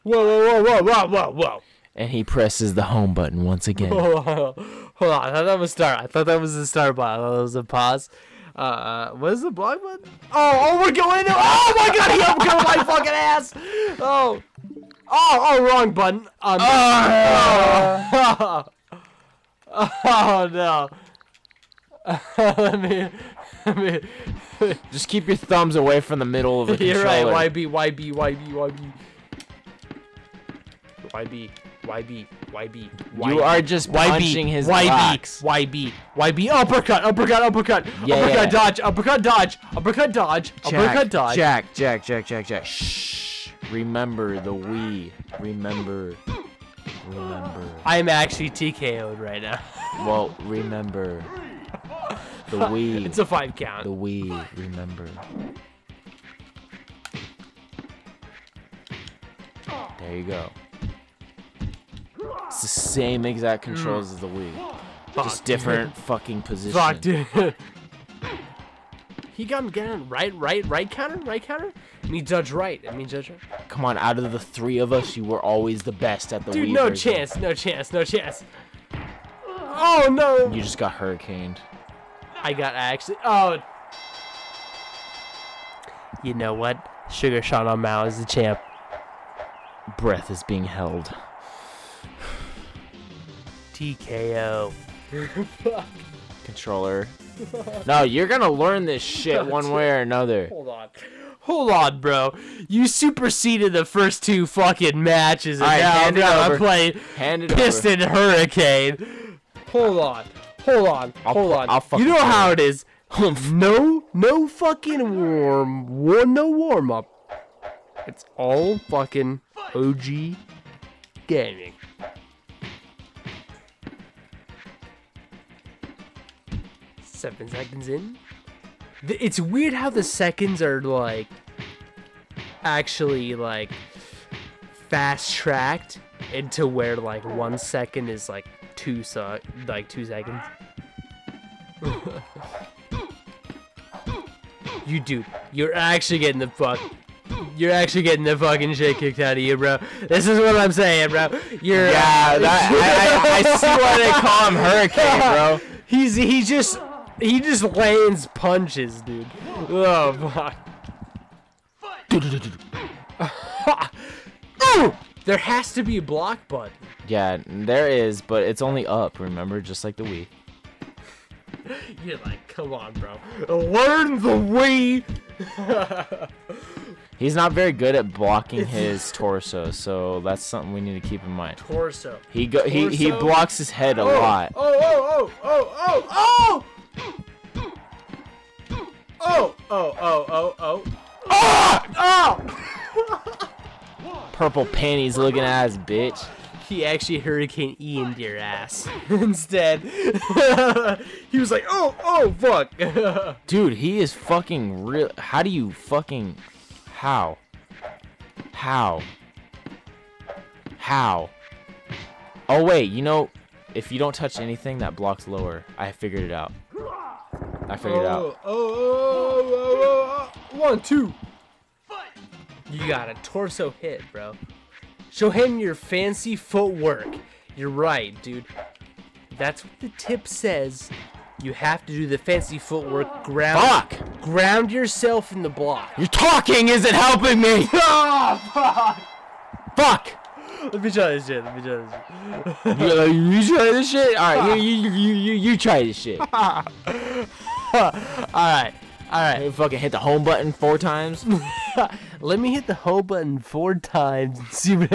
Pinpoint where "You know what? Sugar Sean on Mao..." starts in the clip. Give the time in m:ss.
1:26.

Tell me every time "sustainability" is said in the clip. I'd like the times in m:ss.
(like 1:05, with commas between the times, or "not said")
not said.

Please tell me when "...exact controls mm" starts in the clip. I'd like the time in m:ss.
1:03.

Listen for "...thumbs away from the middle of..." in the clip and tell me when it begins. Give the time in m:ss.
0:25.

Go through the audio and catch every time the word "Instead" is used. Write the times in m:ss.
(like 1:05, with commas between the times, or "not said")
3:19.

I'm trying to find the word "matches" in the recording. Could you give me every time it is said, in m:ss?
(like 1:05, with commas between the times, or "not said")
1:45.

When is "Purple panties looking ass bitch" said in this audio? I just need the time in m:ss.
3:14.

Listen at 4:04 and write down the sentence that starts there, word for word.
All right, you you you you, you try this shit.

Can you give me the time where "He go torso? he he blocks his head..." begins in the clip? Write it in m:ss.
3:02.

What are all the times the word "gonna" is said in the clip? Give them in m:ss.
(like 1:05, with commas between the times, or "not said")
1:38, 1:46.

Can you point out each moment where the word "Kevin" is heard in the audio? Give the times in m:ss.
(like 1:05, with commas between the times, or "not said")
not said.